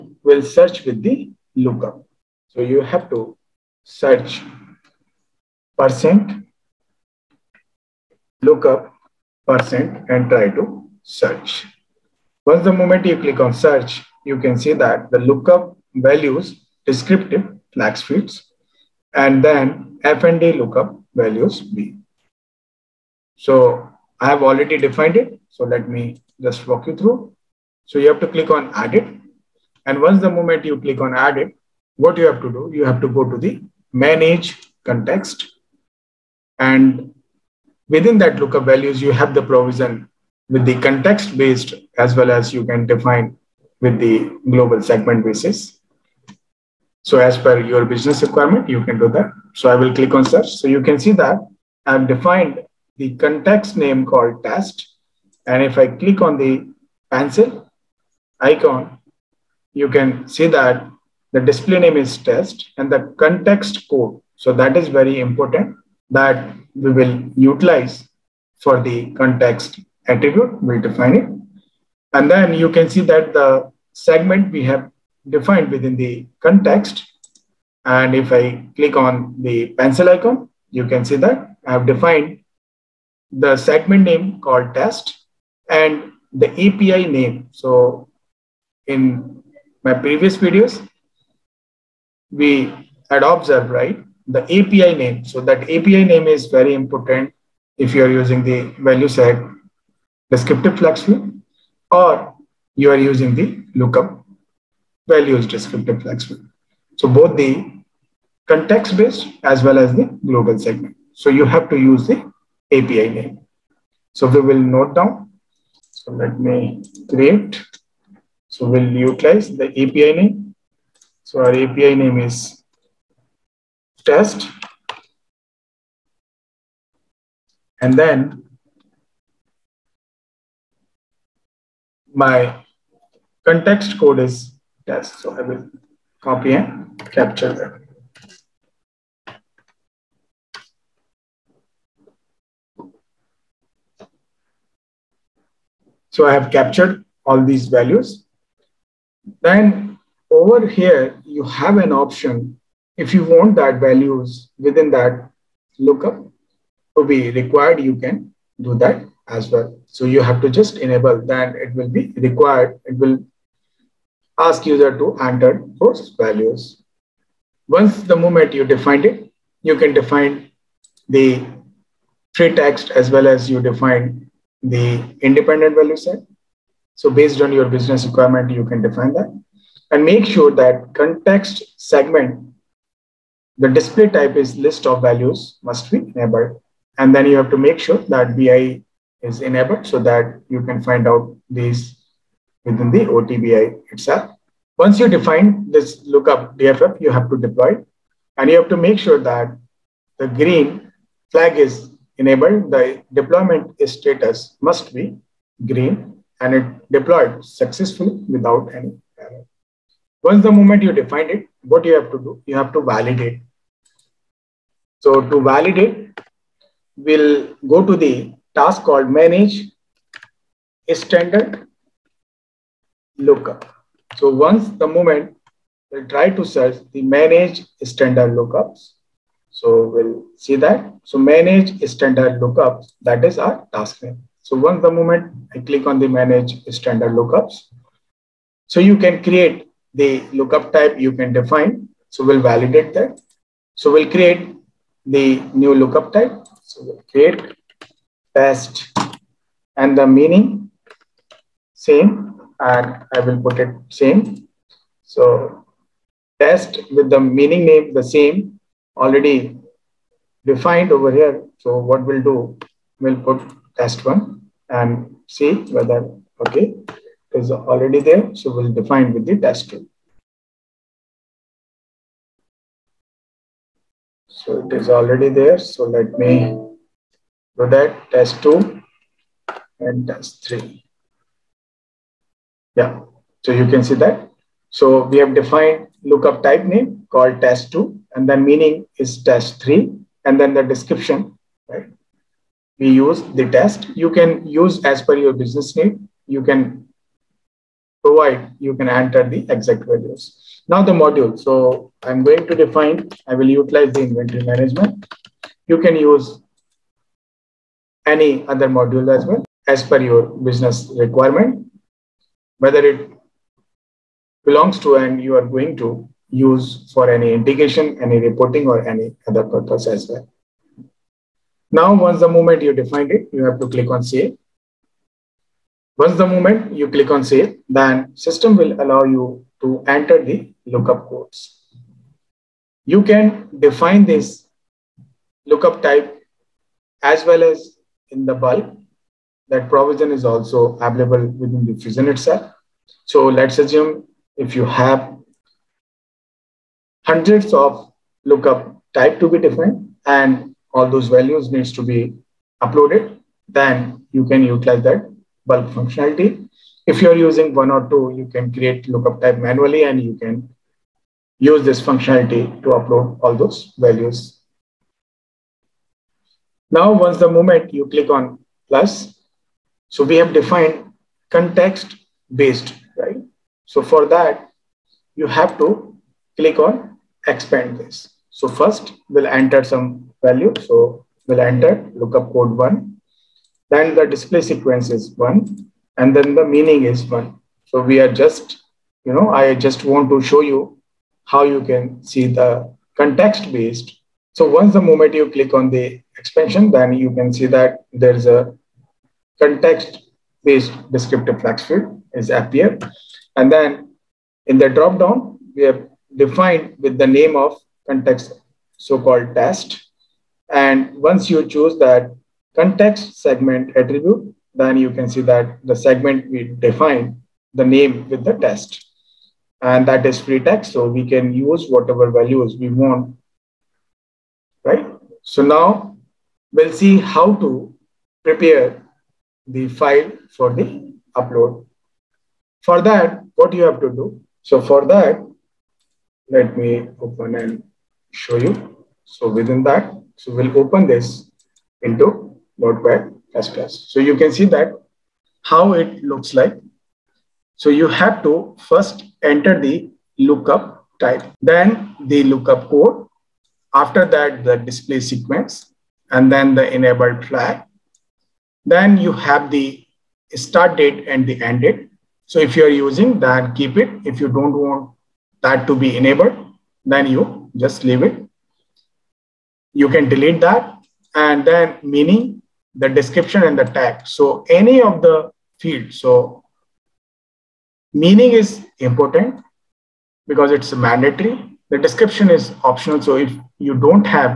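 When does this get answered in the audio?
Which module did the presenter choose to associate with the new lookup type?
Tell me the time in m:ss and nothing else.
5:04.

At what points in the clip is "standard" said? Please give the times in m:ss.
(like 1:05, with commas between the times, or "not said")
3:41, 3:47, 3:51, 3:56.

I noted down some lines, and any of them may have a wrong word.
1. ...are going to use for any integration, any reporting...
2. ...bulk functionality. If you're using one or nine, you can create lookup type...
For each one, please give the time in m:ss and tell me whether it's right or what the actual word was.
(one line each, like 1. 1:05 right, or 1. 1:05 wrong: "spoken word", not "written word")
1. 5:15 right
2. 5:55 wrong: "two", not "nine".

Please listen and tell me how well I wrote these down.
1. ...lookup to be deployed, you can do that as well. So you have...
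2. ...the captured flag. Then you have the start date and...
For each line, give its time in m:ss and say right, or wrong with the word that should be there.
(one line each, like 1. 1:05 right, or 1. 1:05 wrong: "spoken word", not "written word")
1. 2:35 wrong: "required", not "deployed"
2. 7:36 wrong: "enabled", not "captured".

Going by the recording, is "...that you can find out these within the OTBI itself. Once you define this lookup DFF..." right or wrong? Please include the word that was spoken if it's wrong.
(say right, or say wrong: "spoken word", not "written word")
right.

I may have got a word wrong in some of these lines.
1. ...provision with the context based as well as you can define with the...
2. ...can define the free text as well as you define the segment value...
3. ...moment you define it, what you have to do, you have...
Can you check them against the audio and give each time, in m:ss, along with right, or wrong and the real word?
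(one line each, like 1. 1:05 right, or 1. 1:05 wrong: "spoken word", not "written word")
1. 0:39 right
2. 2:49 wrong: "independent", not "segment"
3. 3:30 right.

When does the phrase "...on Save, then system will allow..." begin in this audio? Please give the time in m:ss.
5:27.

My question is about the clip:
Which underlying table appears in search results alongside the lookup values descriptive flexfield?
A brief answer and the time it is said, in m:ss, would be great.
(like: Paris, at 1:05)
FND lookup values B, at 0:20.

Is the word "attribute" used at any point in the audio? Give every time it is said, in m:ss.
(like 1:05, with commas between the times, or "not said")
1:10, 6:53.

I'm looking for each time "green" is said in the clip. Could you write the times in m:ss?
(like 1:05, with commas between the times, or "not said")
3:20, 3:25.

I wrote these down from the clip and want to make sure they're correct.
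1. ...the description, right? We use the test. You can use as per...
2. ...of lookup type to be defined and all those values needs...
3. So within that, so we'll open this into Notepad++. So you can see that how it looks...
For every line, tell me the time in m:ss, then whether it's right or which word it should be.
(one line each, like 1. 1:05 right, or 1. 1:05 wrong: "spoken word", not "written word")
1. 4:50 right
2. 5:47 right
3. 7:19 right.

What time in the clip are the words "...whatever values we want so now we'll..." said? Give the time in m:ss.
7:01.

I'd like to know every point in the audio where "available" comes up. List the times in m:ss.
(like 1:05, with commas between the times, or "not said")
5:40.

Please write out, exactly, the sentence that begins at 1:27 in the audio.
So in my previous videos, we had observed, right, the API name.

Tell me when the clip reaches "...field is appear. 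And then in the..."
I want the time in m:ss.
6:41.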